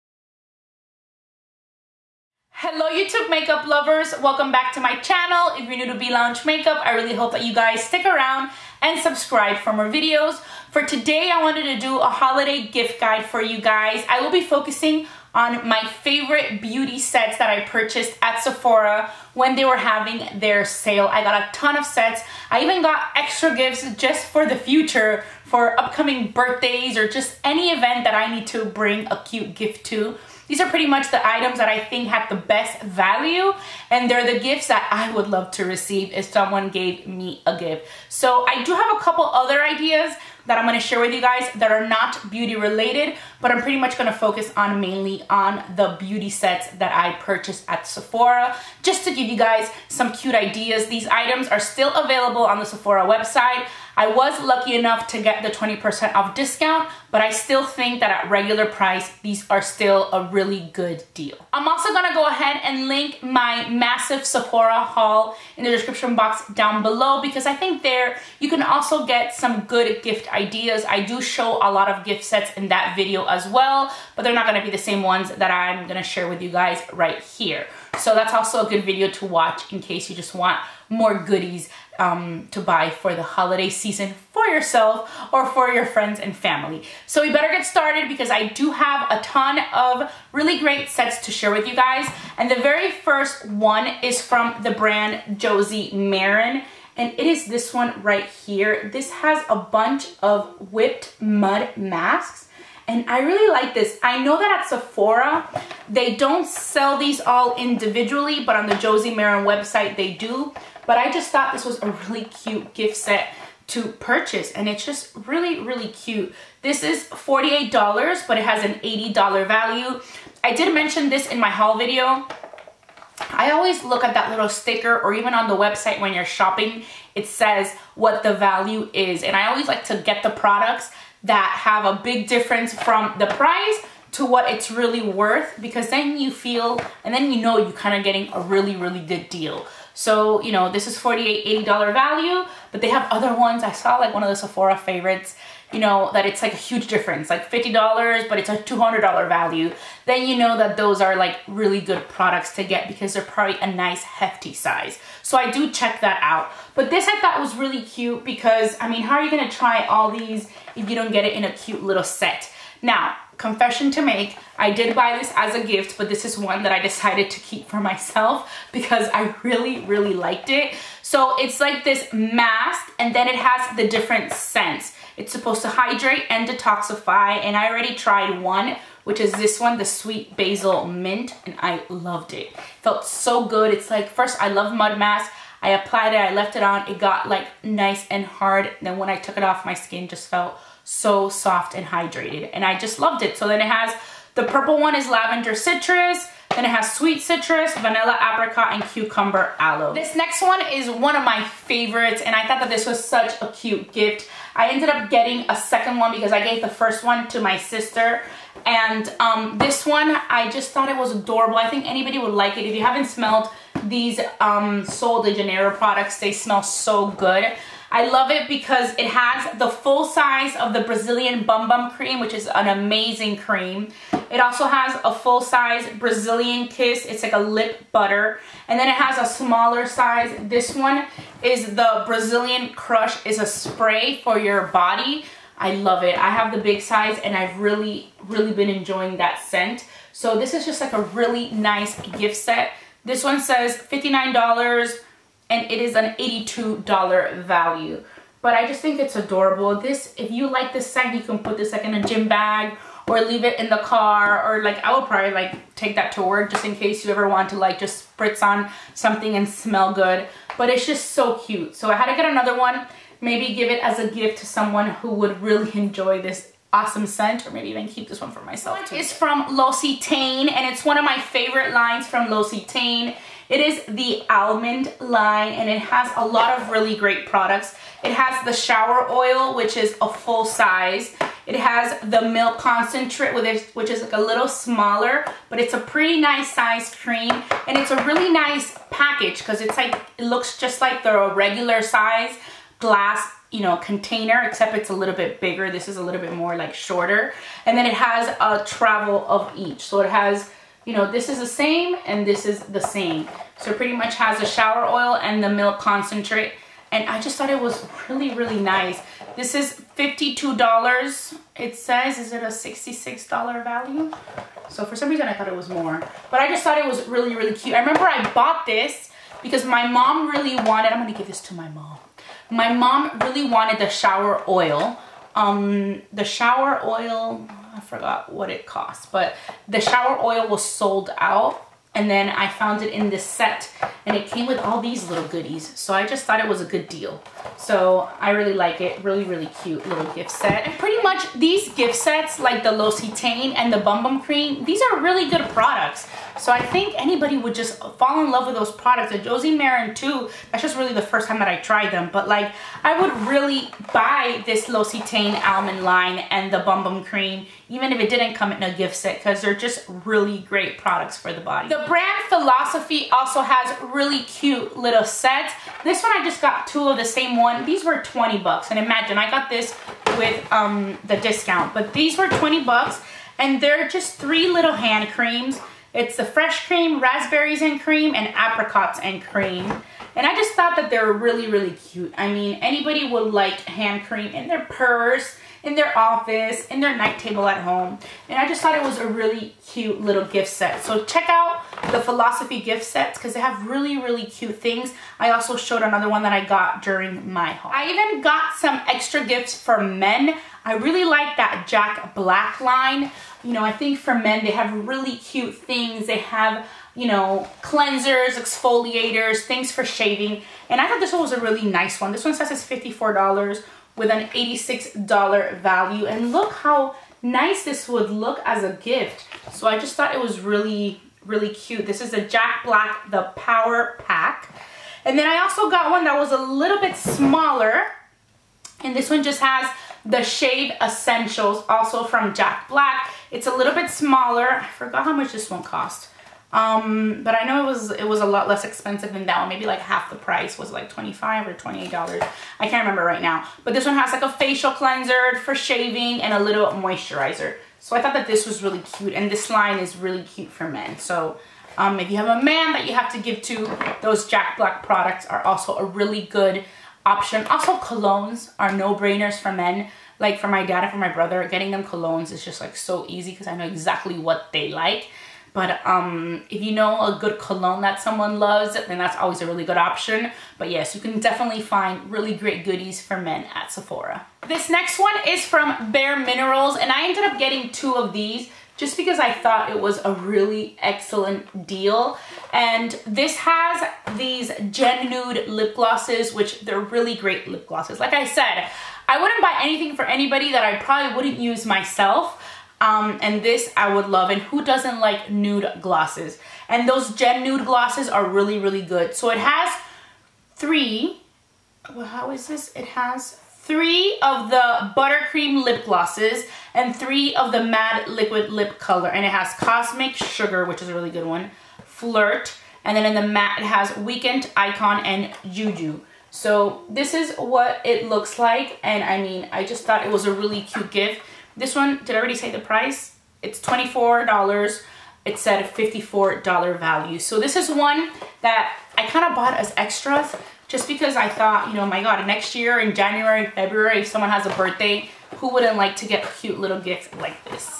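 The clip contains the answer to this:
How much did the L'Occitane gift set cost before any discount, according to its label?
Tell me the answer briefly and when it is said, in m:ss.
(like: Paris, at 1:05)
$52, at 5:09.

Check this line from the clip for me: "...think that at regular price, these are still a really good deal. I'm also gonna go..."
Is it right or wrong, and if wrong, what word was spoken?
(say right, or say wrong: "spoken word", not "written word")
right.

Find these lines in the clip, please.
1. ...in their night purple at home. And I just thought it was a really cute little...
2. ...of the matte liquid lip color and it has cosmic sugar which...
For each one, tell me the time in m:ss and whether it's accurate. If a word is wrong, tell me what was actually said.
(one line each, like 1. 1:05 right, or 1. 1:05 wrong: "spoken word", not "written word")
1. 6:26 wrong: "table", not "purple"
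2. 8:27 right.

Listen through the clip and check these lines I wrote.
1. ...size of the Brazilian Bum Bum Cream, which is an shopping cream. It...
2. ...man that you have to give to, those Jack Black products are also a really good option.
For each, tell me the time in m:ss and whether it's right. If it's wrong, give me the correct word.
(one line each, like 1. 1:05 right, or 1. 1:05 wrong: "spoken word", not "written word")
1. 3:40 wrong: "amazing", not "shopping"
2. 7:32 right.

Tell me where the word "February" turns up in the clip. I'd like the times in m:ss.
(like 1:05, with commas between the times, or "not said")
8:53.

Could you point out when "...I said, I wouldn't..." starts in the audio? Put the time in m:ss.
8:08.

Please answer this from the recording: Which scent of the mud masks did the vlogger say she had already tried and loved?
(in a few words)
Sweet Basil Mint.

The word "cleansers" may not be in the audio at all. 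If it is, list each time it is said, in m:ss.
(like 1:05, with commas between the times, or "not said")
6:47, 7:24.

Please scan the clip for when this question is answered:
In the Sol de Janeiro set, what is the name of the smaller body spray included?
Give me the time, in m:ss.
3:52.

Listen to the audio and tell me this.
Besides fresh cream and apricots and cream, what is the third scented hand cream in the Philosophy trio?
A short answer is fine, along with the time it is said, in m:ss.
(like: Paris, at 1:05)
raspberries and cream, at 6:17.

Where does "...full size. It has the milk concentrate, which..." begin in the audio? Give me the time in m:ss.
4:40.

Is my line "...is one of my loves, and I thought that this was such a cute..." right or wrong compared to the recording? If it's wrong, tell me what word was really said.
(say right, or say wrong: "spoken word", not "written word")
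wrong: "favorites", not "loves".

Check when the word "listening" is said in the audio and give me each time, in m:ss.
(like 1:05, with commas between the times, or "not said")
not said.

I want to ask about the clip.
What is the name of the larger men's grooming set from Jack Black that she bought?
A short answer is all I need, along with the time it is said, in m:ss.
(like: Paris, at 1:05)
Power Pack, at 7:03.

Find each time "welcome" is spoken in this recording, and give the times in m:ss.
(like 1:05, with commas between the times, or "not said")
0:04.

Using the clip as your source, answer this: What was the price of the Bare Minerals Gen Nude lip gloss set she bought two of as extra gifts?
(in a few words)
$24.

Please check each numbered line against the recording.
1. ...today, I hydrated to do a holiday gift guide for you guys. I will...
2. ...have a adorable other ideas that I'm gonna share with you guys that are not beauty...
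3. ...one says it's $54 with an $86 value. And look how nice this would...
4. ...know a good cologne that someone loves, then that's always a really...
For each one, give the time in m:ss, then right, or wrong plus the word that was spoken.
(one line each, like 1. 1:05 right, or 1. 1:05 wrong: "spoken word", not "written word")
1. 0:10 wrong: "wanted", not "hydrated"
2. 0:38 wrong: "couple", not "adorable"
3. 6:52 right
4. 7:46 right.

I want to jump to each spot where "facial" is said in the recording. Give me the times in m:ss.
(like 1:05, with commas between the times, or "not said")
7:24.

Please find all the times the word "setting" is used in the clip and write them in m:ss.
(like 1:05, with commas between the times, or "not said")
not said.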